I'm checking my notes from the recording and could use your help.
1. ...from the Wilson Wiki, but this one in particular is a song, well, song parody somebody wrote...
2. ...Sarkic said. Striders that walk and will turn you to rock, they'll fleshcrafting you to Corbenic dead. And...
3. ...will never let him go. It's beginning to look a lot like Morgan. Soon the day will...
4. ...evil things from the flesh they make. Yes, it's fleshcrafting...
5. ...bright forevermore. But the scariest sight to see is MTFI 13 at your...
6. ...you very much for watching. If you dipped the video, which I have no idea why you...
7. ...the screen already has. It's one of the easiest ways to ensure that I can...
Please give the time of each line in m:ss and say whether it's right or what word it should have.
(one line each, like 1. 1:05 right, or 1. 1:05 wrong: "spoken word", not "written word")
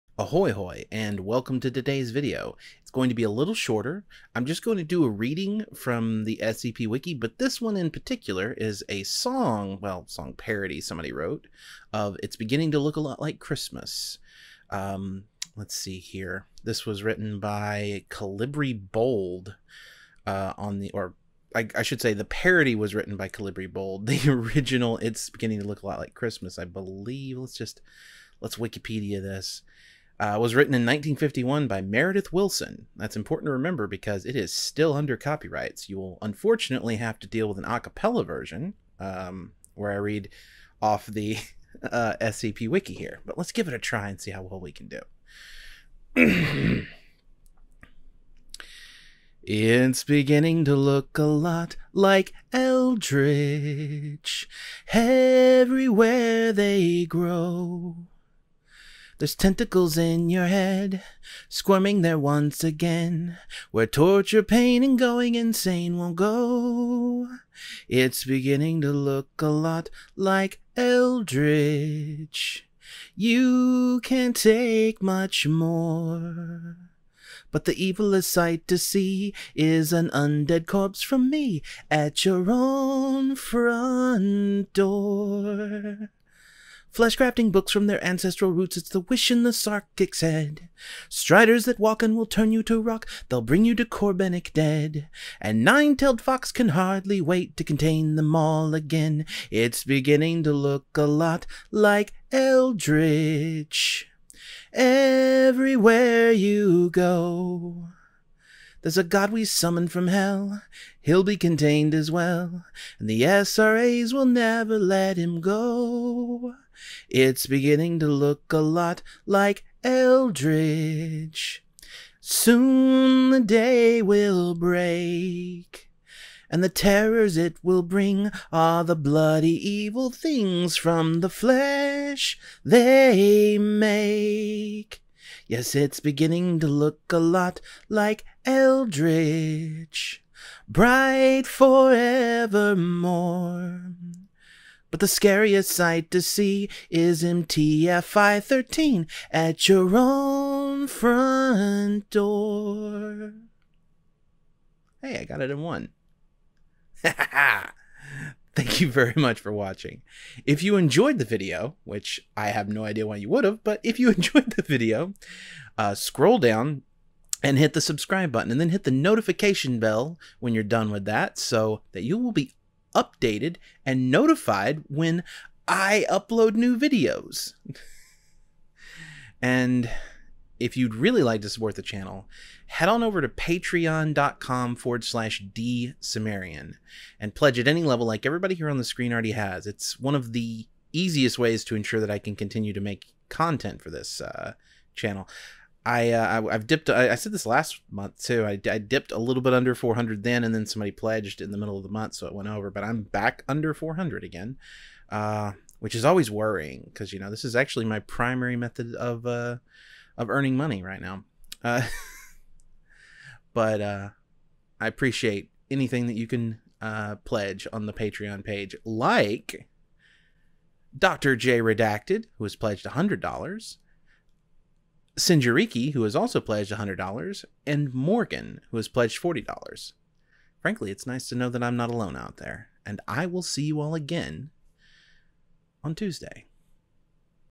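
1. 0:05 wrong: "SCP", not "Wilson"
2. 1:29 wrong: "bring", not "fleshcrafting"
3. 1:54 wrong: "Eldritch", not "Morgan"
4. 2:09 wrong: "beginning", not "fleshcrafting"
5. 2:20 right
6. 2:38 wrong: "enjoyed", not "dipped"
7. 3:08 right.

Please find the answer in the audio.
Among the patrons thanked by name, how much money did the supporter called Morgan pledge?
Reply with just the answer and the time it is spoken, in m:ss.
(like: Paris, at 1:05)
$40, at 3:49.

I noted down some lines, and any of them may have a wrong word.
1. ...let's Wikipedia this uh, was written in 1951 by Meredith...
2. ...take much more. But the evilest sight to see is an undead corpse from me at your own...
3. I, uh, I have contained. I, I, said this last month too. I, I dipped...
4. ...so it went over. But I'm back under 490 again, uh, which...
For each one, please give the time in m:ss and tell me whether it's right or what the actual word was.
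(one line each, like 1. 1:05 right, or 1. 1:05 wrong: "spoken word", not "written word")
1. 0:28 right
2. 1:14 right
3. 3:15 wrong: "dipped", not "contained"
4. 3:22 wrong: "400", not "490".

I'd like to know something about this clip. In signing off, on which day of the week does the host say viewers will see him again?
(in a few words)
Tuesday.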